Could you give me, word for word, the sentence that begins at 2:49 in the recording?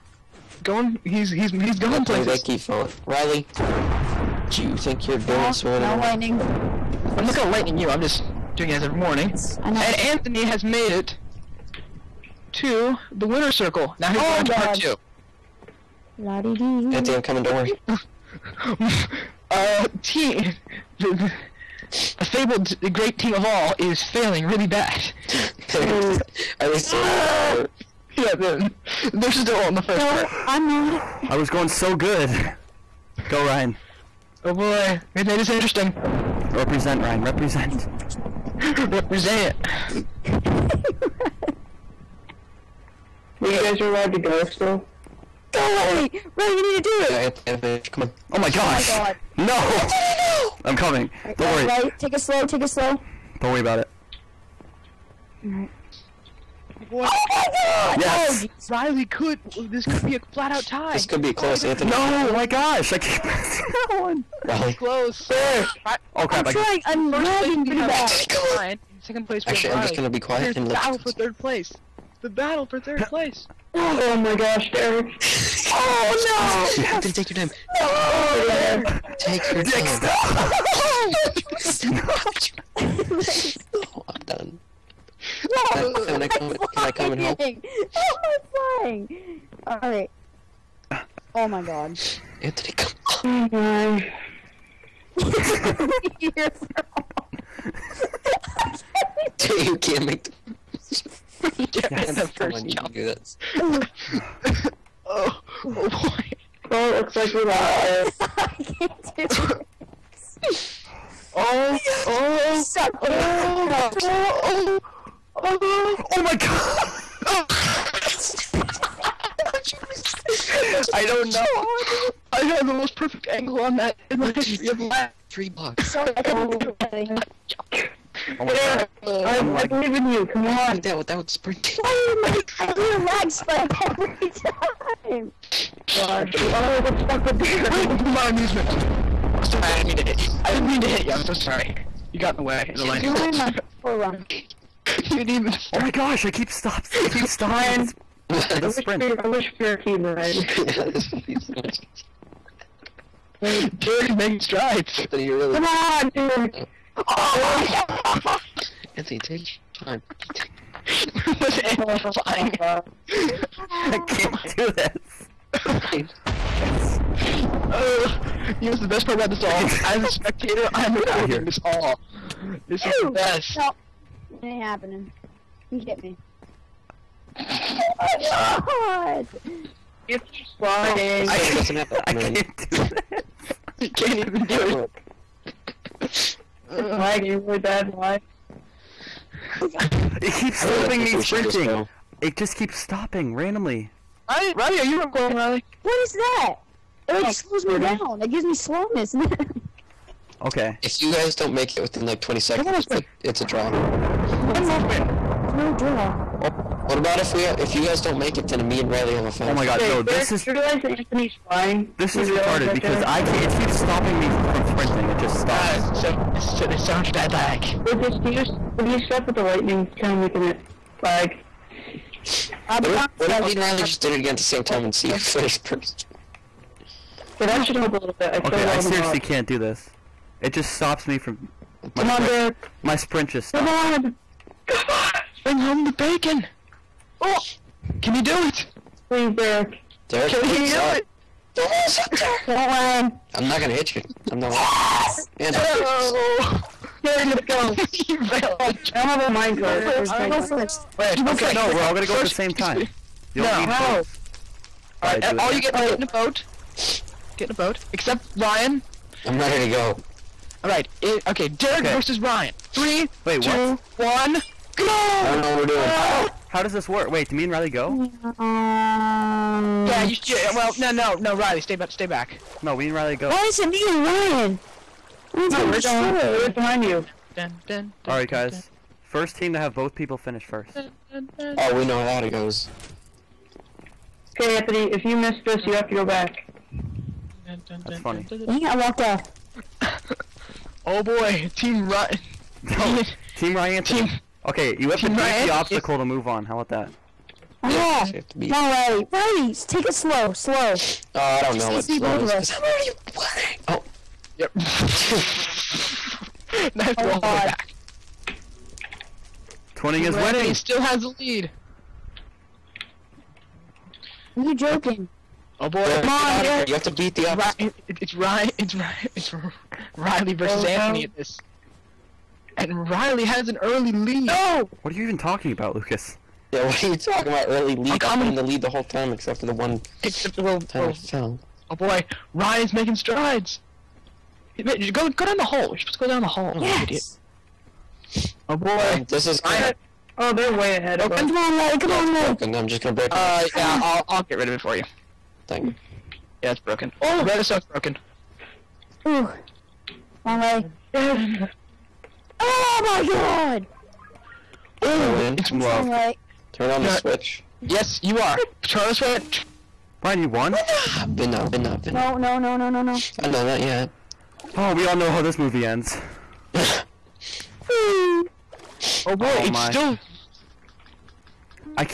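As a spectator, I'm recording this all.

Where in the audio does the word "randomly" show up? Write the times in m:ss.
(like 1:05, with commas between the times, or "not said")
3:13.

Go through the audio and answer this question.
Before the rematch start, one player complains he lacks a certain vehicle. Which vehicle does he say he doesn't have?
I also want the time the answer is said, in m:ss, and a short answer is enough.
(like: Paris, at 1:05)
Minecart, at 4:09.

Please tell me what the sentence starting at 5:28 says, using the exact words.
I've been in the lead the whole time except for the one except, well, time well, I fell.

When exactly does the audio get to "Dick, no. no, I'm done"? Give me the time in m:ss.
1:21.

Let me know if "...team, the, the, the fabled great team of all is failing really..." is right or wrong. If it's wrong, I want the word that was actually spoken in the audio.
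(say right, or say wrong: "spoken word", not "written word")
right.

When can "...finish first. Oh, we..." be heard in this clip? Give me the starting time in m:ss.
4:40.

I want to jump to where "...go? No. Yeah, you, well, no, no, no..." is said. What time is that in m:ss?
4:27.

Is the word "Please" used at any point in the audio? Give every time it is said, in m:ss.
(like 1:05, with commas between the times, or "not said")
3:59.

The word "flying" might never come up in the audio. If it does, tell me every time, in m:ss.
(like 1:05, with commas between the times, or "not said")
1:28, 3:00, 3:31.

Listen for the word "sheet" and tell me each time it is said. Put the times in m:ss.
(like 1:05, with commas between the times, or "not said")
not said.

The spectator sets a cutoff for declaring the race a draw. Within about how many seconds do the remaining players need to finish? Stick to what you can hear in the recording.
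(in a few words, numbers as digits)
20 seconds.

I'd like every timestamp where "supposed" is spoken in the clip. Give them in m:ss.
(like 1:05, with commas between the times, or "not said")
5:35.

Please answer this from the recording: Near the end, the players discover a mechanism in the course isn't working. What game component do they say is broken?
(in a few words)
Redstone.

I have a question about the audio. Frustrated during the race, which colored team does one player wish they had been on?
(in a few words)
Team red.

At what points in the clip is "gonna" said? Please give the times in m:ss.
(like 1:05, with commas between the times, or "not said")
0:07, 1:09, 4:03, 4:11, 5:42.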